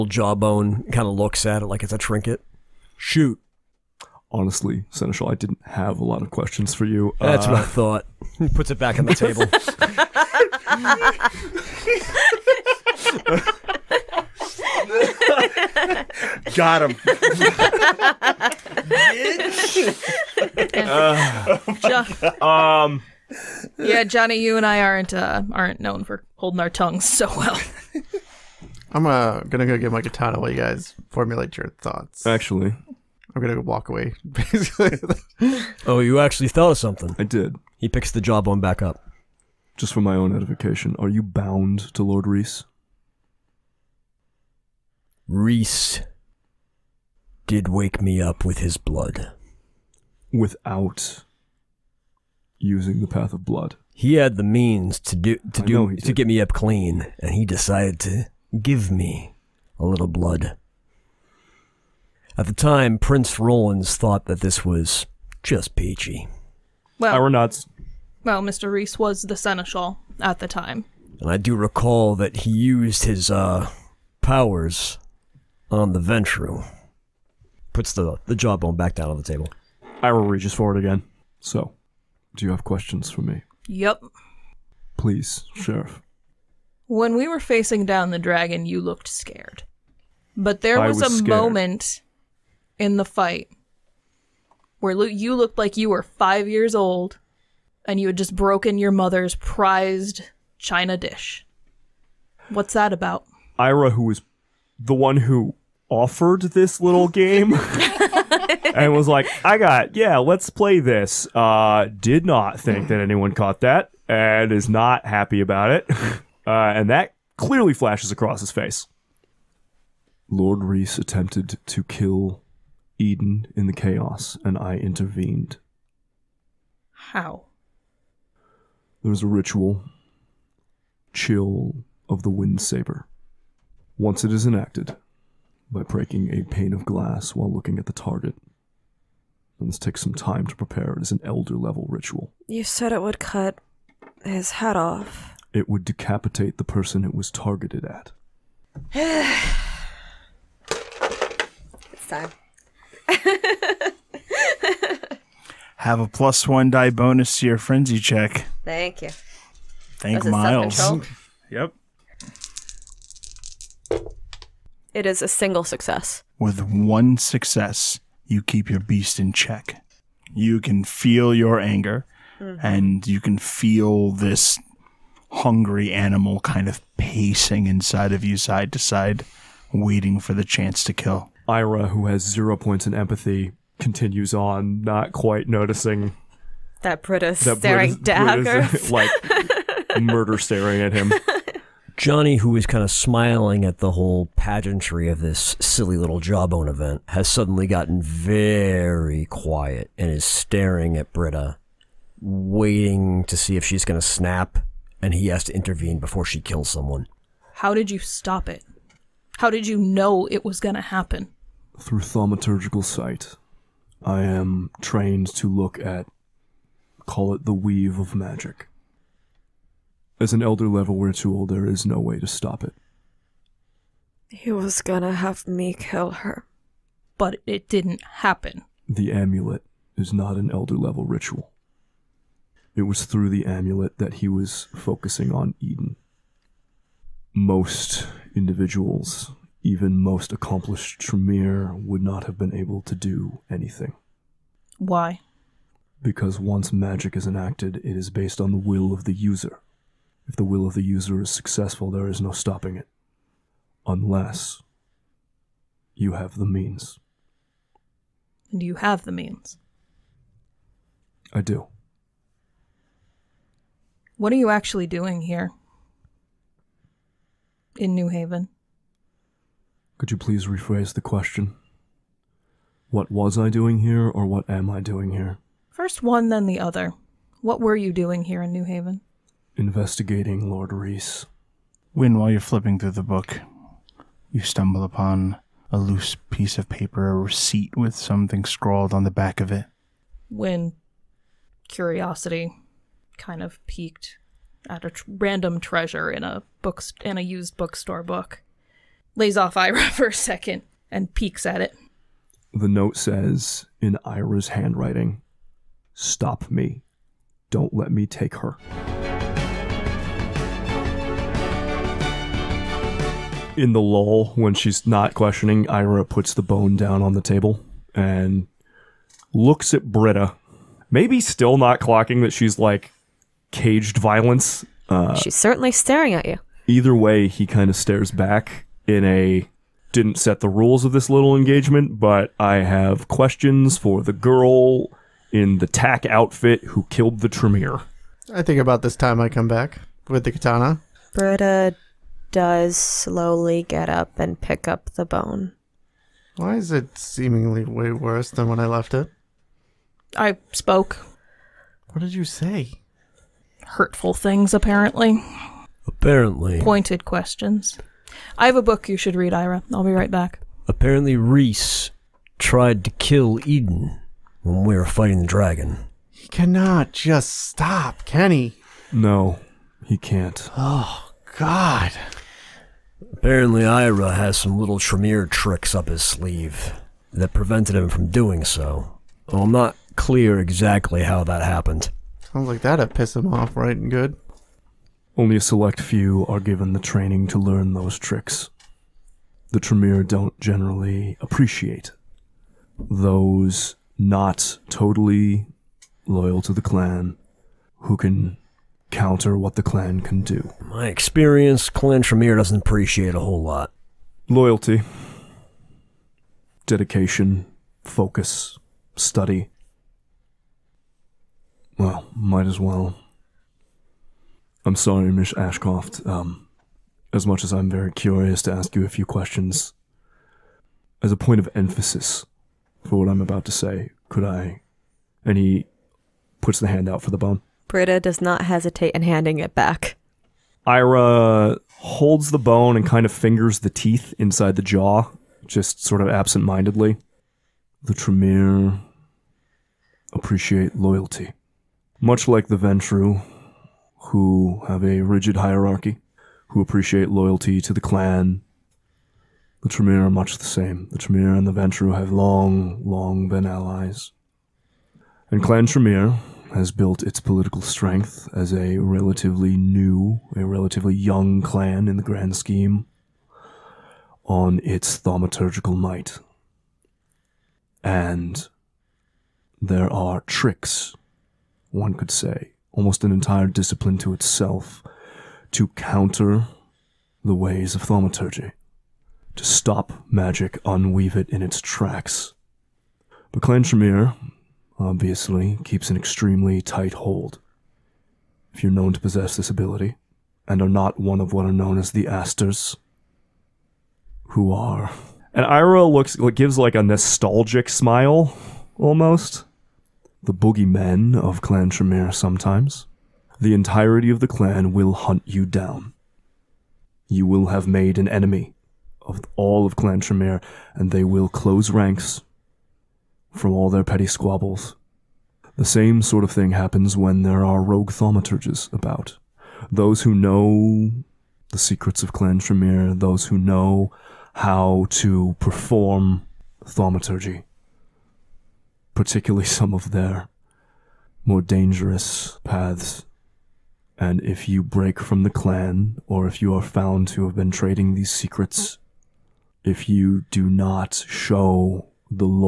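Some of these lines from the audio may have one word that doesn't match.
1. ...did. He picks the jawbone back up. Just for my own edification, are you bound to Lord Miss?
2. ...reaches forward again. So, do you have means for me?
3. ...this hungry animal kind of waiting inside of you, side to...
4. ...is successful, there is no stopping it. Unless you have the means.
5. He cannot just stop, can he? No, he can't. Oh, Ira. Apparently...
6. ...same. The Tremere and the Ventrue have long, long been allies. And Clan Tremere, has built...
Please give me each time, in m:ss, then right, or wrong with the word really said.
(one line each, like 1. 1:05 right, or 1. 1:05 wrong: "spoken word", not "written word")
1. 0:37 wrong: "Reese", not "Miss"
2. 1:20 wrong: "questions", not "means"
3. 2:54 wrong: "pacing", not "waiting"
4. 4:11 right
5. 6:06 wrong: "God", not "Ira"
6. 7:30 right.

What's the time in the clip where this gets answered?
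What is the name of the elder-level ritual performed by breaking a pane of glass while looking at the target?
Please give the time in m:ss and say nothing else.
2:11.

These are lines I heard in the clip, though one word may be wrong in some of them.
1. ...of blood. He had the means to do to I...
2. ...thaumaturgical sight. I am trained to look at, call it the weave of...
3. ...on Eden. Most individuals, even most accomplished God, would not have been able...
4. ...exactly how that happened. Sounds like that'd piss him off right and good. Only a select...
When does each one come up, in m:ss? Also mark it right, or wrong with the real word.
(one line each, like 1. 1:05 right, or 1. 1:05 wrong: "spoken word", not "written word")
1. 0:53 right
2. 3:31 right
3. 3:55 wrong: "Tremere", not "God"
4. 6:20 right.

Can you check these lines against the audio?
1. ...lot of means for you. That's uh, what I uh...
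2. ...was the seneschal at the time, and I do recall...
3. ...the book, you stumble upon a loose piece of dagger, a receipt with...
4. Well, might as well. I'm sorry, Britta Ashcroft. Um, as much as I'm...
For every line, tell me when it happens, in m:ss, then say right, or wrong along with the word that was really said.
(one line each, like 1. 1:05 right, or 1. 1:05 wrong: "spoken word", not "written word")
1. 0:06 wrong: "questions", not "means"
2. 1:08 right
3. 4:42 wrong: "paper", not "dagger"
4. 6:51 wrong: "Miss", not "Britta".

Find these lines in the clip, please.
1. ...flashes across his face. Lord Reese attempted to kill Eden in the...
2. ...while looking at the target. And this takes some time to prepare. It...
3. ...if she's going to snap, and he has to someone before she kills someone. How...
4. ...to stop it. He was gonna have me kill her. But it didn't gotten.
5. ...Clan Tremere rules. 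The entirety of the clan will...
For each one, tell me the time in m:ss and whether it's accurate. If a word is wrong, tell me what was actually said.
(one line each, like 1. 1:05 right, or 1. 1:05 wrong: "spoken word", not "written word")
1. 1:57 right
2. 2:17 right
3. 3:23 wrong: "intervene", not "someone"
4. 3:42 wrong: "happen", not "gotten"
5. 8:21 wrong: "sometimes", not "rules".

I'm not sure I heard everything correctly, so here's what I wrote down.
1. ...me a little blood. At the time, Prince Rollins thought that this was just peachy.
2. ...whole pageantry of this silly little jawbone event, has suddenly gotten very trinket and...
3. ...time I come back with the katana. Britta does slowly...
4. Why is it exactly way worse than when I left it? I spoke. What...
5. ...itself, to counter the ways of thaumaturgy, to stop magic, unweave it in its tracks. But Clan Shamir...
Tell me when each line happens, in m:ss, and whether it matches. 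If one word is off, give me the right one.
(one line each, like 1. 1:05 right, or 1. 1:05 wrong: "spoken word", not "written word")
1. 0:58 right
2. 3:13 wrong: "quiet", not "trinket"
3. 5:38 right
4. 5:46 wrong: "seemingly", not "exactly"
5. 7:54 right.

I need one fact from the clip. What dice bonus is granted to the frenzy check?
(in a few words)
plus one die.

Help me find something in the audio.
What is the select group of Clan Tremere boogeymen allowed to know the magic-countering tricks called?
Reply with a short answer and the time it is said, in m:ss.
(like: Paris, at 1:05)
Astors, at 8:12.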